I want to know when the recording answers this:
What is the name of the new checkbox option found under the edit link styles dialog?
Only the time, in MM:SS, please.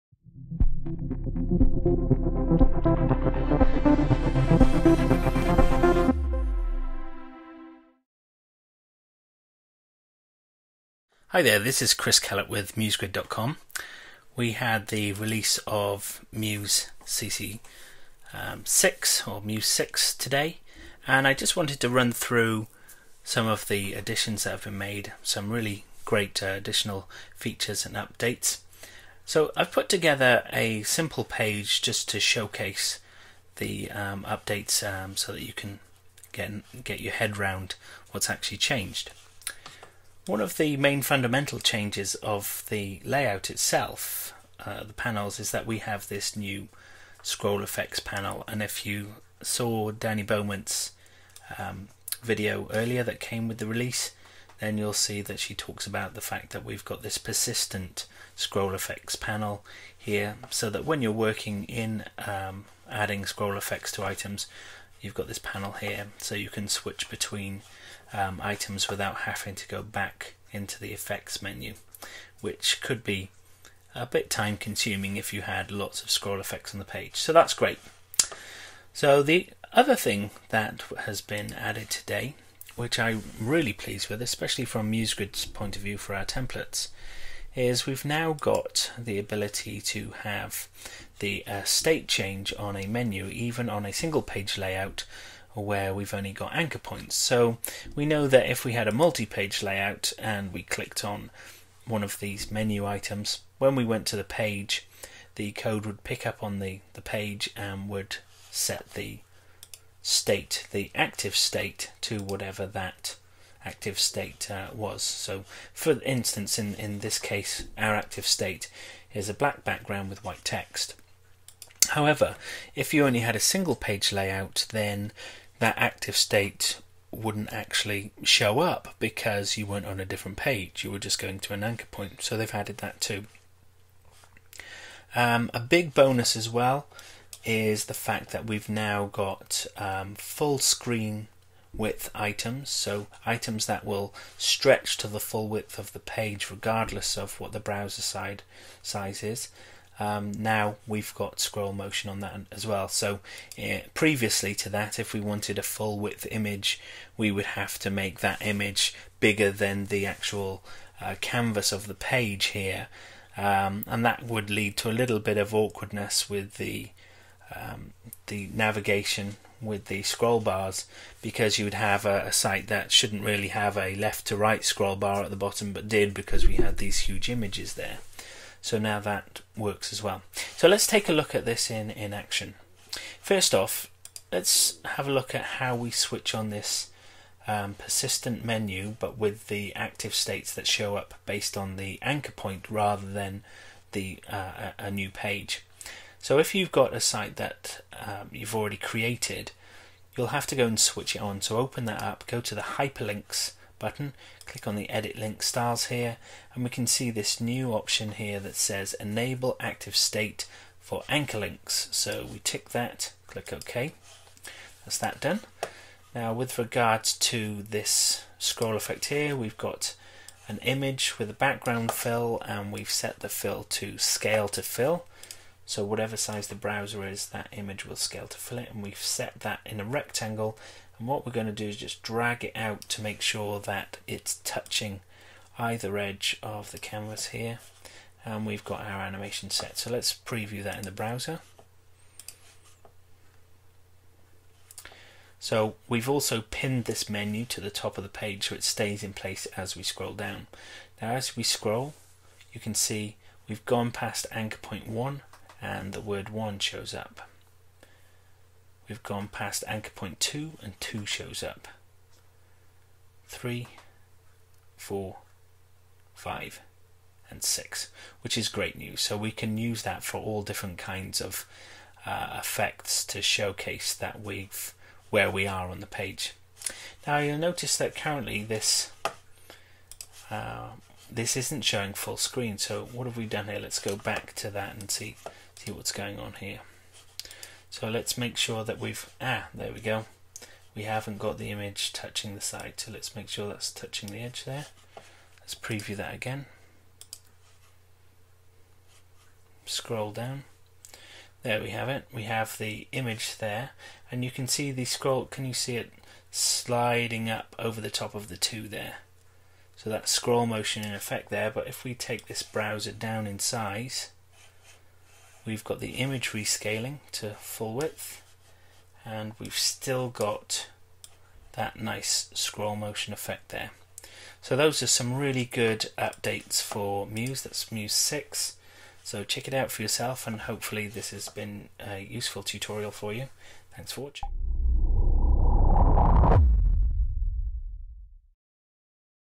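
03:28.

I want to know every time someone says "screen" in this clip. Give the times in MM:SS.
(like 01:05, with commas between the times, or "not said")
02:20, 04:42.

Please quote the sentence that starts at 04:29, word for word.
So we can use that for all different kinds of uh, effects to showcase that we've where we are on the page.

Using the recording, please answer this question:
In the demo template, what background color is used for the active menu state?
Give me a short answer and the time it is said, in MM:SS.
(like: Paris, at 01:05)
black, at 01:59.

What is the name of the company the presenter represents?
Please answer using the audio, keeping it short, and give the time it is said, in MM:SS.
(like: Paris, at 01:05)
MuseGrid.com, at 00:12.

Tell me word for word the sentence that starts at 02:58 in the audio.
So now that works as well.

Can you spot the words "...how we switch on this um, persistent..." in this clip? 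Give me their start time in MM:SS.
03:05.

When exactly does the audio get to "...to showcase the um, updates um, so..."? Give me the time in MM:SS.
00:32.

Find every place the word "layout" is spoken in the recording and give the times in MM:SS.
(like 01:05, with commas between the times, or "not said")
00:43, 01:34, 01:39, 02:04.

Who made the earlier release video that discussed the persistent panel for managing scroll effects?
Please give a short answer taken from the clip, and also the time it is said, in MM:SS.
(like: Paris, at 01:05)
Dani Beaumont, at 00:49.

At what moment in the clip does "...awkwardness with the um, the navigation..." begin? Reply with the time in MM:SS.
02:45.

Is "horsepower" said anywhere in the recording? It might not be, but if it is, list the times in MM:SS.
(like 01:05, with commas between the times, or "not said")
not said.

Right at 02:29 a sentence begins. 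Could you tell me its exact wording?
Um, now we've got scroll motion on that as well.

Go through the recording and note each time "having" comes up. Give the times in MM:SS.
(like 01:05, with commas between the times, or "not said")
01:09.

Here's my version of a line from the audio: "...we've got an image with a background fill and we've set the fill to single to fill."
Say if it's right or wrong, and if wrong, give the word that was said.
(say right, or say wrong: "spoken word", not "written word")
wrong: "scale", not "single".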